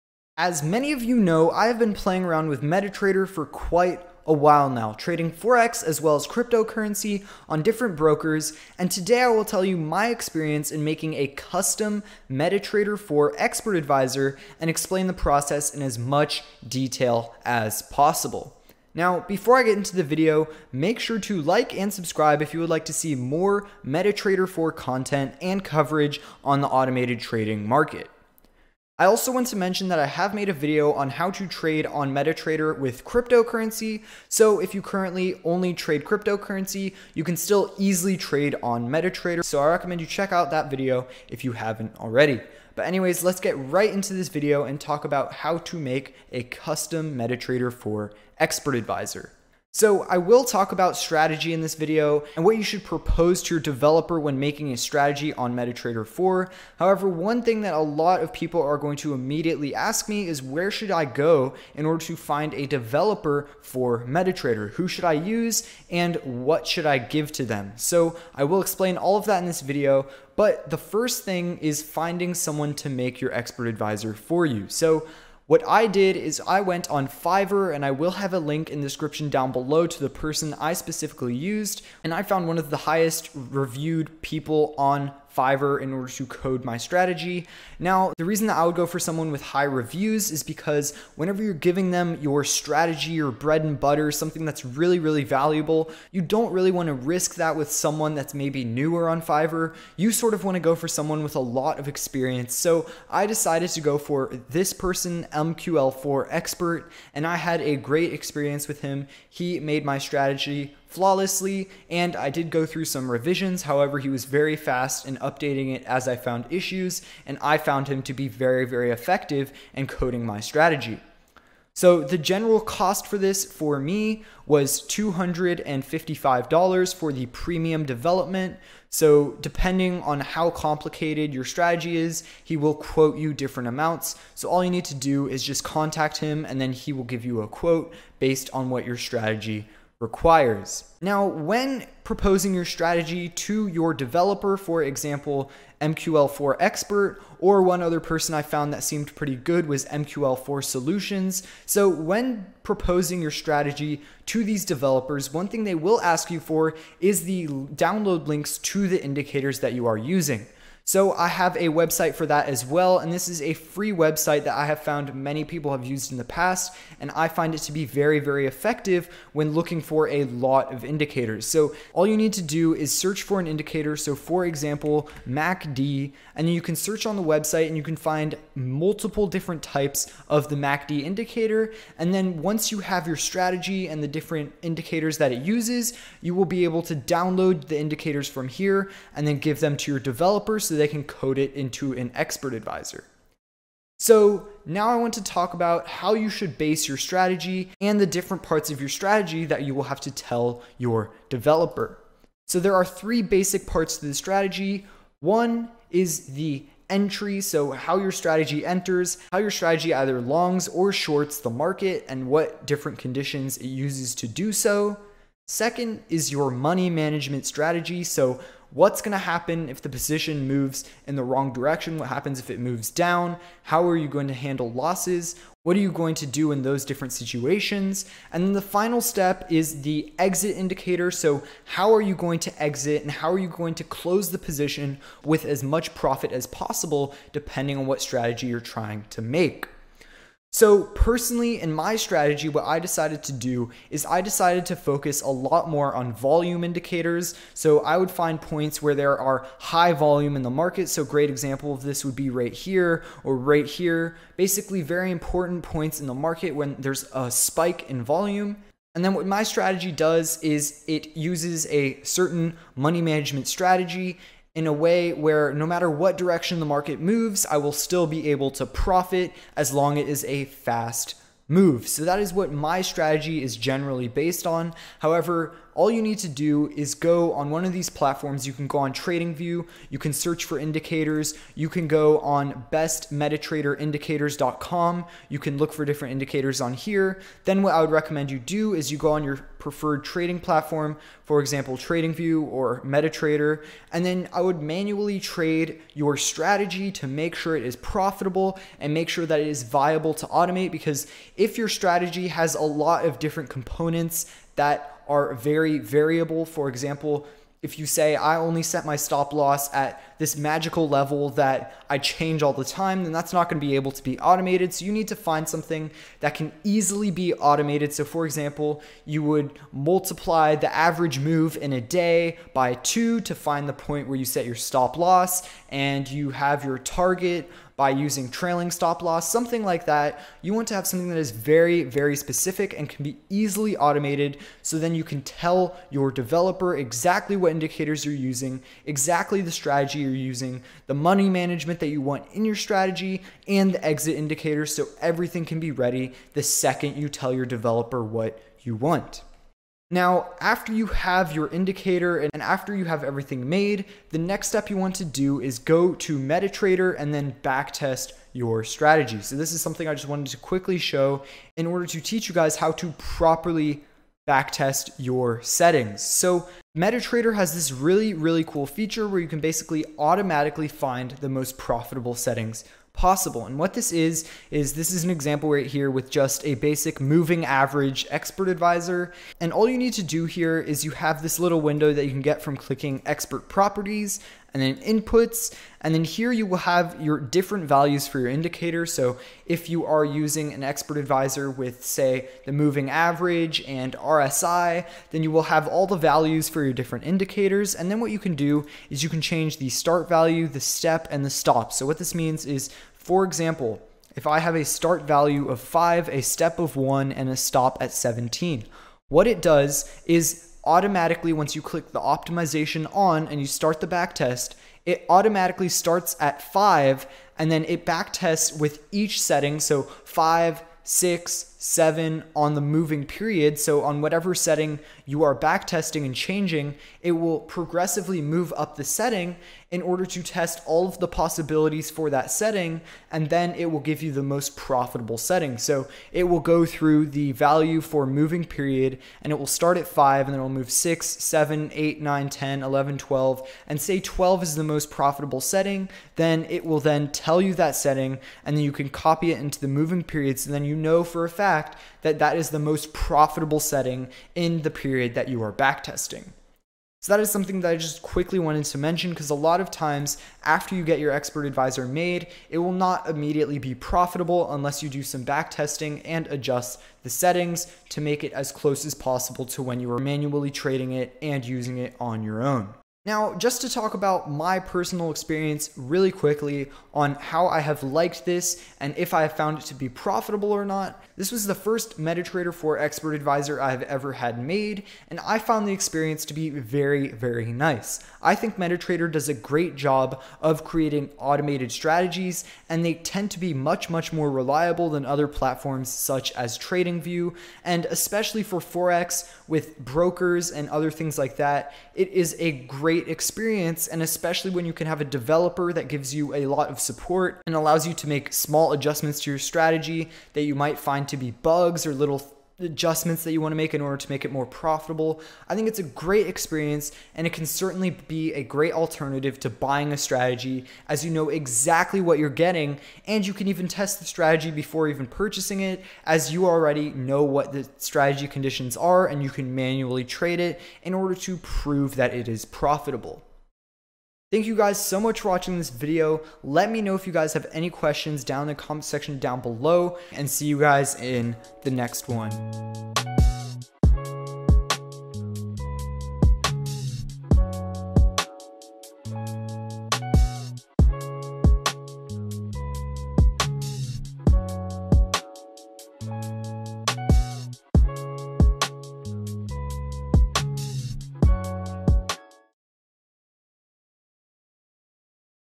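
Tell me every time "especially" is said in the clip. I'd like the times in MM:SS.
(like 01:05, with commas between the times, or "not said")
08:17, 08:24.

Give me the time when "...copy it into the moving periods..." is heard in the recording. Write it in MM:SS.
07:28.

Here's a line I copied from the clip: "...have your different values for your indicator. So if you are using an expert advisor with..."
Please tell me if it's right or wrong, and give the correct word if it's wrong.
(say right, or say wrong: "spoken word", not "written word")
right.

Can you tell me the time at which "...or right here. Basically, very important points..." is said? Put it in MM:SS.
04:13.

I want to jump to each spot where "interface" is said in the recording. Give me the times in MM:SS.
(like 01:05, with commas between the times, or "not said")
not said.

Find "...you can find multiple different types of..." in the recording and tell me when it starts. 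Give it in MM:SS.
02:57.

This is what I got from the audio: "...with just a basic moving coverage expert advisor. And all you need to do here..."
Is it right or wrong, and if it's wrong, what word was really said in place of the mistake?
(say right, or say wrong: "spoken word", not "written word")
wrong: "average", not "coverage".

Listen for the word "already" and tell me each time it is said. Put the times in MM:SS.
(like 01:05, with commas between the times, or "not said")
00:41, 08:46.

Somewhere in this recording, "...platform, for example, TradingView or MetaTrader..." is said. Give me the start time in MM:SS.
04:50.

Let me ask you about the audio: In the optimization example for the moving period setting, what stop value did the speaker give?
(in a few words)
17.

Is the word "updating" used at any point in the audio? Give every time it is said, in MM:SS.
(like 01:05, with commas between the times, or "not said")
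01:55.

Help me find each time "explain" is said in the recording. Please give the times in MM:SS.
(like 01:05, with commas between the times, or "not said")
00:14, 01:08.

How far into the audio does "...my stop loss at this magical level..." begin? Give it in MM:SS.
05:08.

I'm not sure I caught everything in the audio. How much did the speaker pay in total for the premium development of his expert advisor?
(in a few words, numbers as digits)
$255.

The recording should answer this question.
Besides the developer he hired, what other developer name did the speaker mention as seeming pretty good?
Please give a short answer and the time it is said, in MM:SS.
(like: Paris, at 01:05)
MQL4 Solutions, at 02:29.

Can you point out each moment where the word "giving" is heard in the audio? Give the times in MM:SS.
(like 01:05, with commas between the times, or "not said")
01:31.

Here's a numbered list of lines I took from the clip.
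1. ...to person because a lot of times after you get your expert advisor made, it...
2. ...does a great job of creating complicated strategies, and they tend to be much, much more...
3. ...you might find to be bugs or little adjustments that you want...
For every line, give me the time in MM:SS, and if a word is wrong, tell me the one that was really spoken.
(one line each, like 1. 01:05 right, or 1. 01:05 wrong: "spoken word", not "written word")
1. 07:38 wrong: "mention", not "person"
2. 08:09 wrong: "automated", not "complicated"
3. 08:30 right.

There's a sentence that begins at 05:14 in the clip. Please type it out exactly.
So you need to find something that can easily be automated.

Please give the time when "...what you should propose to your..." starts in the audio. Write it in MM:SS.
00:52.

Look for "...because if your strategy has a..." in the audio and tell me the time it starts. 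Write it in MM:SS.
05:00.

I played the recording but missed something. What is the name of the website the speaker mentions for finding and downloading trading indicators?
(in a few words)
bestmetatraderindicators.com.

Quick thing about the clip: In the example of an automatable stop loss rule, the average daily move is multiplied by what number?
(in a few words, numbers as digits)
2.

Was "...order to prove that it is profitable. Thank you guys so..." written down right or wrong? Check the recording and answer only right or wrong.
right.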